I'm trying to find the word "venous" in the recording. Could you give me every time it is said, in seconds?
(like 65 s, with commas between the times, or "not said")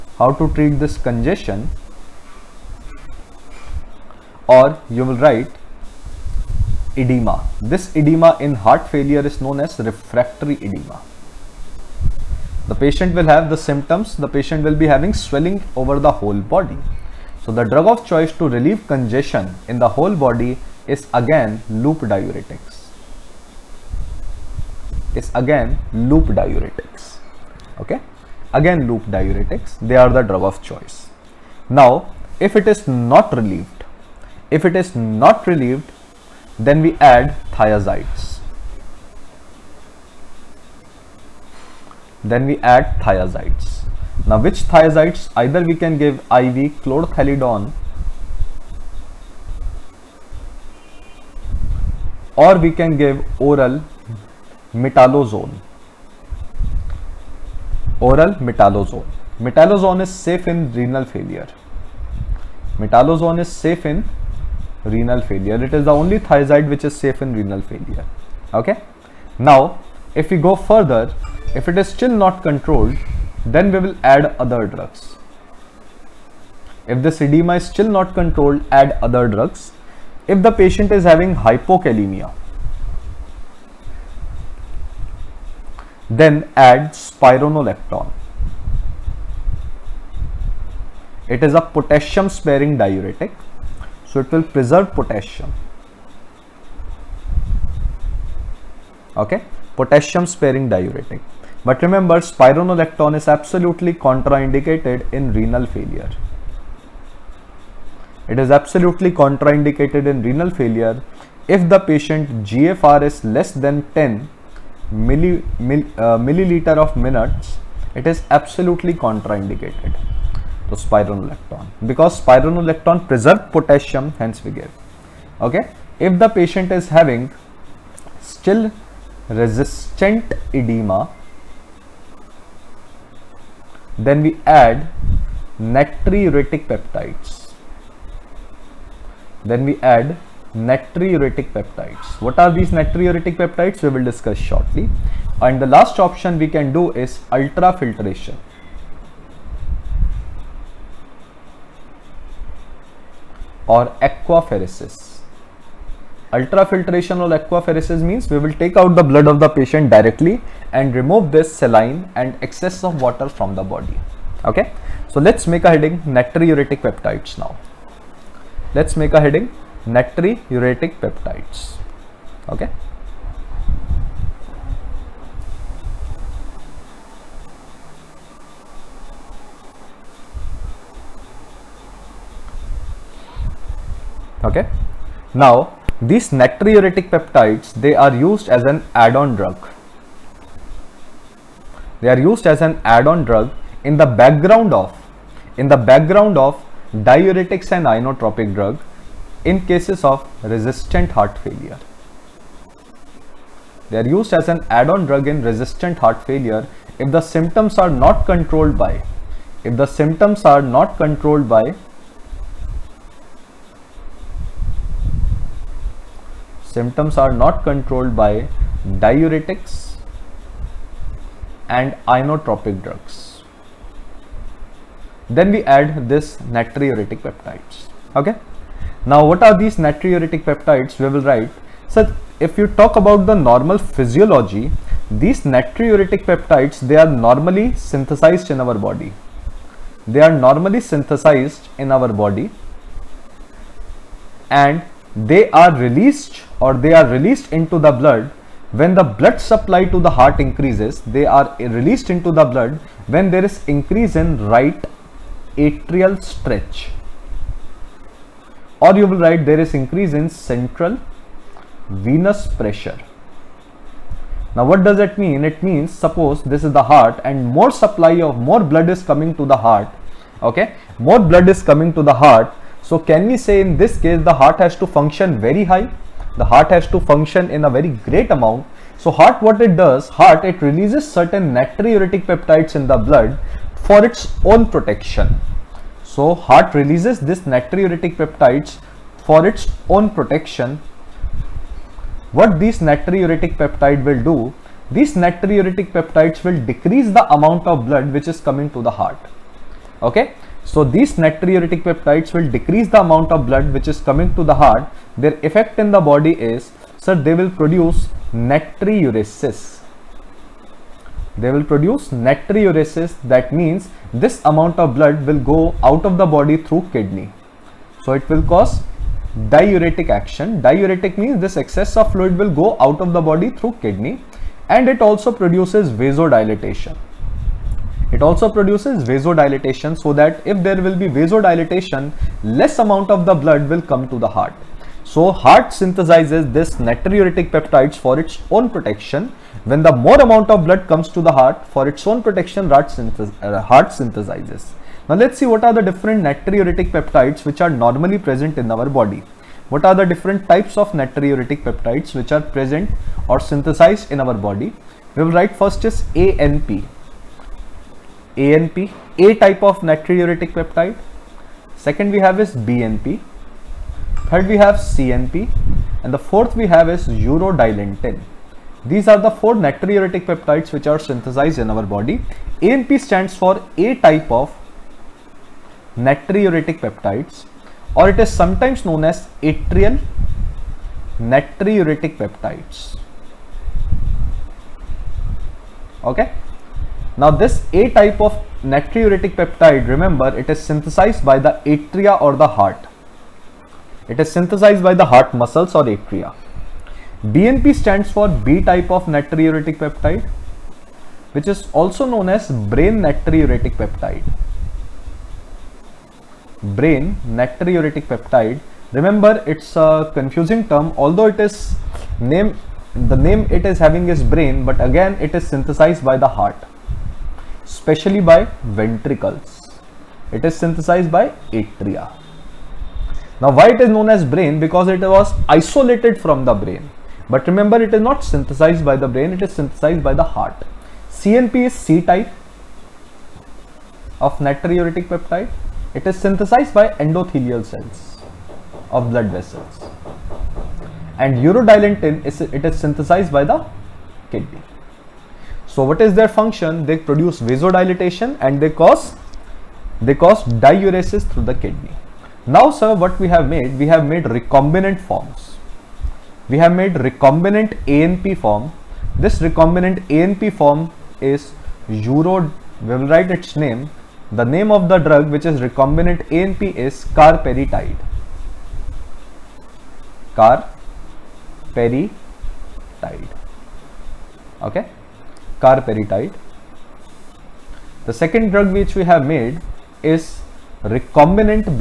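261 s.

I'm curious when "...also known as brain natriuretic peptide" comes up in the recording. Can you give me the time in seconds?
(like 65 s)
401 s.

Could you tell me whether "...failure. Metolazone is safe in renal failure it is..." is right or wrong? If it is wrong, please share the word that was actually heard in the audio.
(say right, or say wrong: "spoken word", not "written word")
right.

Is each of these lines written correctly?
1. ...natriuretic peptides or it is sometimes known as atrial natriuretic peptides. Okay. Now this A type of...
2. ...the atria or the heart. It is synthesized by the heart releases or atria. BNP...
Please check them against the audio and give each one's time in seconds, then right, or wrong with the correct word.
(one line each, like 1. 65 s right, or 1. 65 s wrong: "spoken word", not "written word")
1. 375 s right
2. 391 s wrong: "muscles", not "releases".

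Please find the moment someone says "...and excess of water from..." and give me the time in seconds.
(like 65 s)
162 s.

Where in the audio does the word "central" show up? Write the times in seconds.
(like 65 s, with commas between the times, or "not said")
260 s.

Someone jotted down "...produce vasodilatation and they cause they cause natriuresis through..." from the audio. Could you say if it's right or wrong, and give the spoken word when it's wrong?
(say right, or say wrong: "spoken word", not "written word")
wrong: "diuresis", not "natriuresis".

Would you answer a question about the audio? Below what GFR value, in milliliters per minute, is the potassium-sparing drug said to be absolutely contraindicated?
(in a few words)
10.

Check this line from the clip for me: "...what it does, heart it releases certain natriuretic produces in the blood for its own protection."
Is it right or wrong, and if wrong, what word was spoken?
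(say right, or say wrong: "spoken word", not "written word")
wrong: "peptides", not "produces".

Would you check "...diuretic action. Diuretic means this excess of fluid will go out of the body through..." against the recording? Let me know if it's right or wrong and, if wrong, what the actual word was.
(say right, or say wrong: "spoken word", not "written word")
right.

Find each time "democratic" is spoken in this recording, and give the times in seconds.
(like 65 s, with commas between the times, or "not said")
not said.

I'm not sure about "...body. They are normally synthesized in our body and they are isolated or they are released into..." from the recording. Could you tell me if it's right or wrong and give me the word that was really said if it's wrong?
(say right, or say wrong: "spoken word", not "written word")
wrong: "released", not "isolated".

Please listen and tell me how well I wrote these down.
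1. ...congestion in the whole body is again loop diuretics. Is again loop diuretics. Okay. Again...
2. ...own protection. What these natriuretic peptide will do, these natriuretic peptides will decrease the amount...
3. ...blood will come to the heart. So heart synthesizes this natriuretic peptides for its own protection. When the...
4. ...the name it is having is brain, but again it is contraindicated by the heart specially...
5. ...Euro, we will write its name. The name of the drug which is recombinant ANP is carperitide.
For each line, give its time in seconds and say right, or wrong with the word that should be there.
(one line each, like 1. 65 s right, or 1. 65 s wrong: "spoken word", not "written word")
1. 18 s right
2. 289 s right
3. 333 s right
4. 412 s wrong: "synthesized", not "contraindicated"
5. 461 s right.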